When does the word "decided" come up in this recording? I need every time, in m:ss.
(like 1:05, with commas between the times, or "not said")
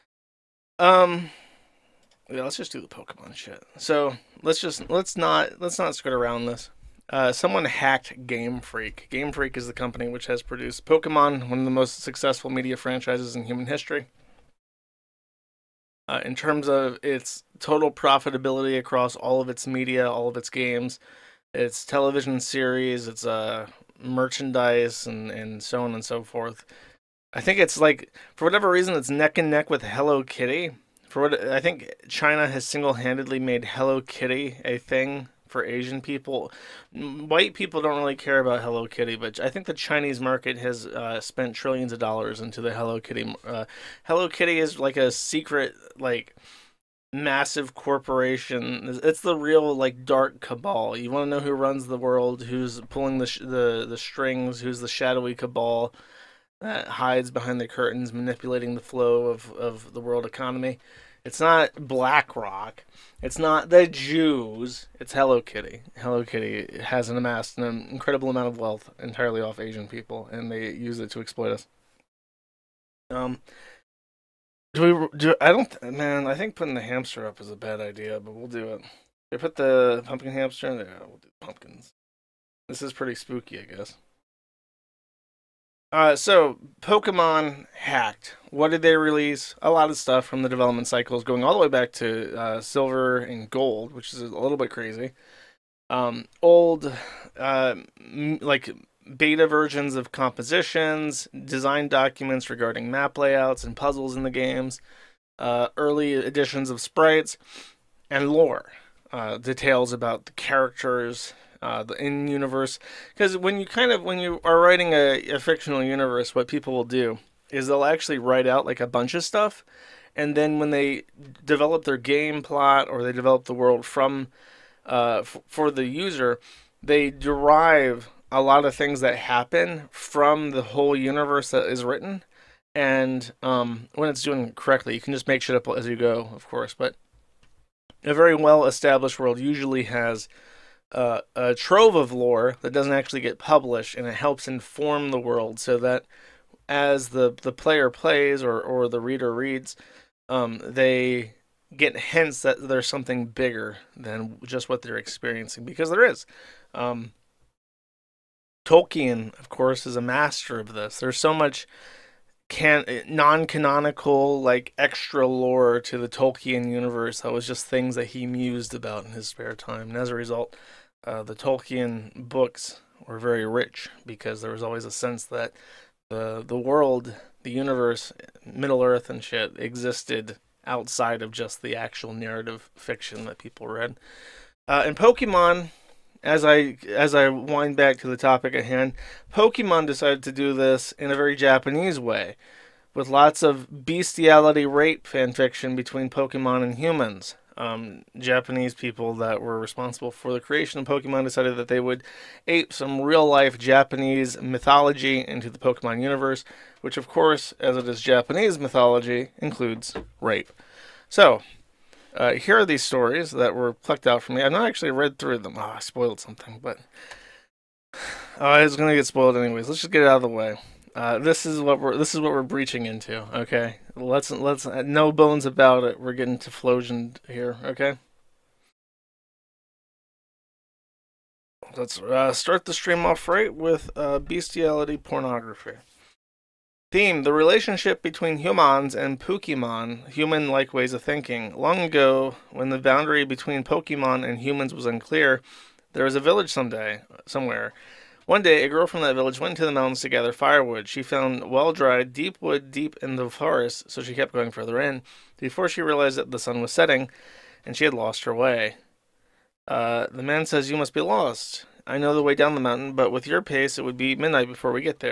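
3:09, 3:21.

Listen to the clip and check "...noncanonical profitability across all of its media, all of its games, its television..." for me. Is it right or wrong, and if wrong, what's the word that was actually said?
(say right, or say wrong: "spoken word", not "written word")
wrong: "total", not "noncanonical".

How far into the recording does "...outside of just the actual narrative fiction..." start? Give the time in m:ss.
3:00.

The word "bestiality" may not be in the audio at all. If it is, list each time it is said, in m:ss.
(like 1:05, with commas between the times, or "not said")
3:13, 3:54.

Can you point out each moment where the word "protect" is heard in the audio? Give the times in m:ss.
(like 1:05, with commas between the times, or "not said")
not said.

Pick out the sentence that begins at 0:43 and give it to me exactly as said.
Uh, Hello Kitty is like a secret, like massive corporation.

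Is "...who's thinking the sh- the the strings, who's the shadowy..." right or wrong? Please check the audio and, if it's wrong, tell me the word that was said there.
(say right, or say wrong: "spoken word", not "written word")
wrong: "pulling", not "thinking".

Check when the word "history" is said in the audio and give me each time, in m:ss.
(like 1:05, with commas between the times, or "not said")
0:13.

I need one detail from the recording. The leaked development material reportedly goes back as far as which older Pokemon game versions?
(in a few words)
Silver and Gold.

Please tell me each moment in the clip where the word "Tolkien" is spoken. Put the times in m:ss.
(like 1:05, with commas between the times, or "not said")
2:38, 2:46, 2:51.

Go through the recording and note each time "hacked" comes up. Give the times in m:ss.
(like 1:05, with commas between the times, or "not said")
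0:07, 1:27.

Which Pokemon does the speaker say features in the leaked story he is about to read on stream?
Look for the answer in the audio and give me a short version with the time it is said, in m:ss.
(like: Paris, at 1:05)
Typhlosion, at 3:46.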